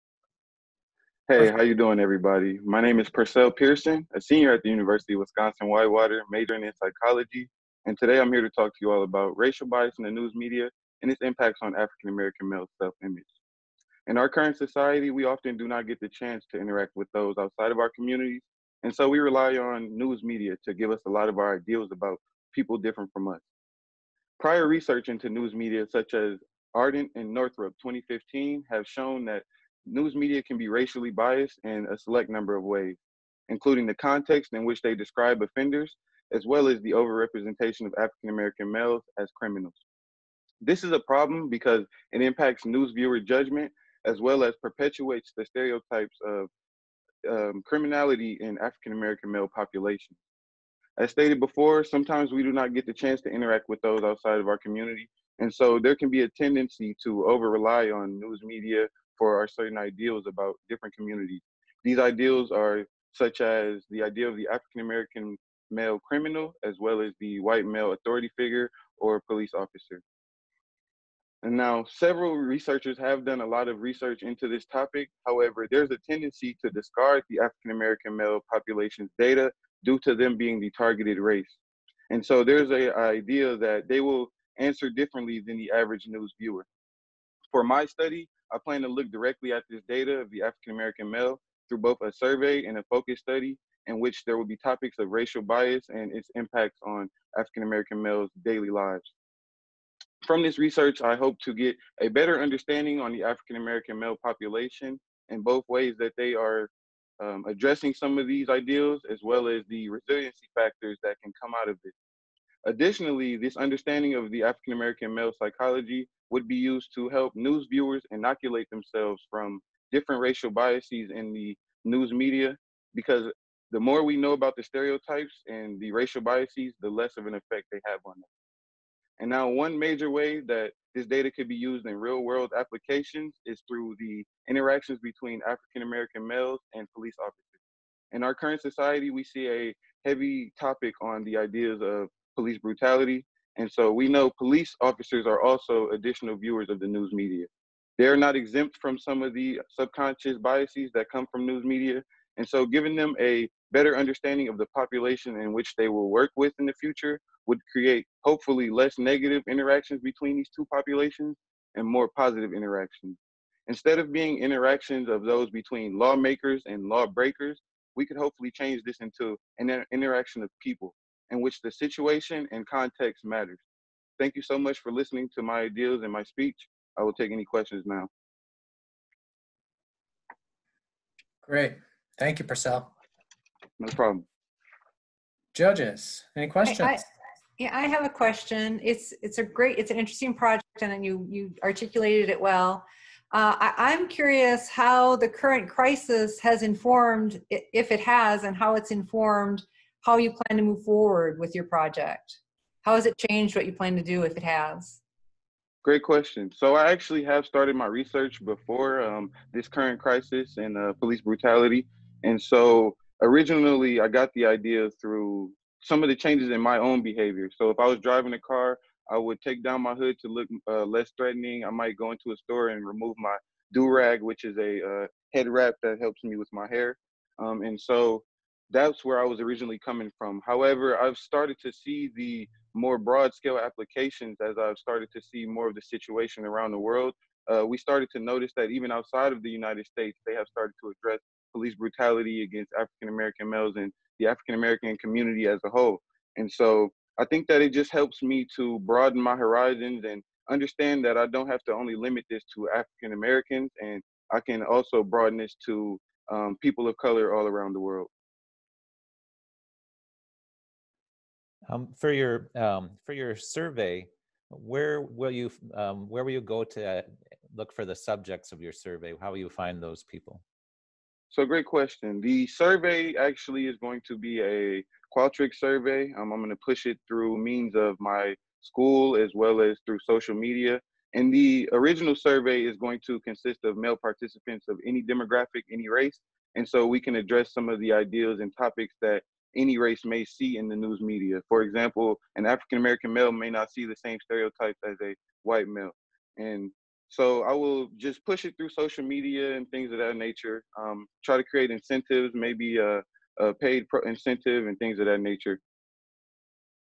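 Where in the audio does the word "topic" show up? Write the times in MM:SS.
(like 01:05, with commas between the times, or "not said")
01:14, 01:34, 02:20, 04:48.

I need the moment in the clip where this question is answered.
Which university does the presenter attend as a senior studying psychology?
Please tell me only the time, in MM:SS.
00:04.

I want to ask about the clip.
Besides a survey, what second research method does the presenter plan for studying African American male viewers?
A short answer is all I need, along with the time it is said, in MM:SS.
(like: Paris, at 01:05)
Focus study, at 01:32.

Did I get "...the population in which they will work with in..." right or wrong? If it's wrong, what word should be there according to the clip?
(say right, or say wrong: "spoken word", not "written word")
right.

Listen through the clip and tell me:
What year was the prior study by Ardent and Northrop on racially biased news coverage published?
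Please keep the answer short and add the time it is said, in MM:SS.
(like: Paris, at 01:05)
2015, at 00:27.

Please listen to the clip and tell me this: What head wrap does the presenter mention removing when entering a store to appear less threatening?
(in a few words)
Do rag.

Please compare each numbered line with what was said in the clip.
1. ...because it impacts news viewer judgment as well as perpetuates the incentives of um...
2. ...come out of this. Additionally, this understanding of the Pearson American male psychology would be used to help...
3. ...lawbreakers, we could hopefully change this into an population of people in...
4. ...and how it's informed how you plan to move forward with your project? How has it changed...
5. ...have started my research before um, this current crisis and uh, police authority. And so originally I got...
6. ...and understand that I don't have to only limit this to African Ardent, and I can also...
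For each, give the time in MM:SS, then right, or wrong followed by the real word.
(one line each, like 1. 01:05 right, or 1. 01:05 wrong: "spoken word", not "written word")
1. 00:41 wrong: "stereotypes", not "incentives"
2. 01:51 wrong: "African", not "Pearson"
3. 02:46 wrong: "interaction", not "population"
4. 03:18 right
5. 03:27 wrong: "brutality", not "authority"
6. 04:10 wrong: "Americans", not "Ardent".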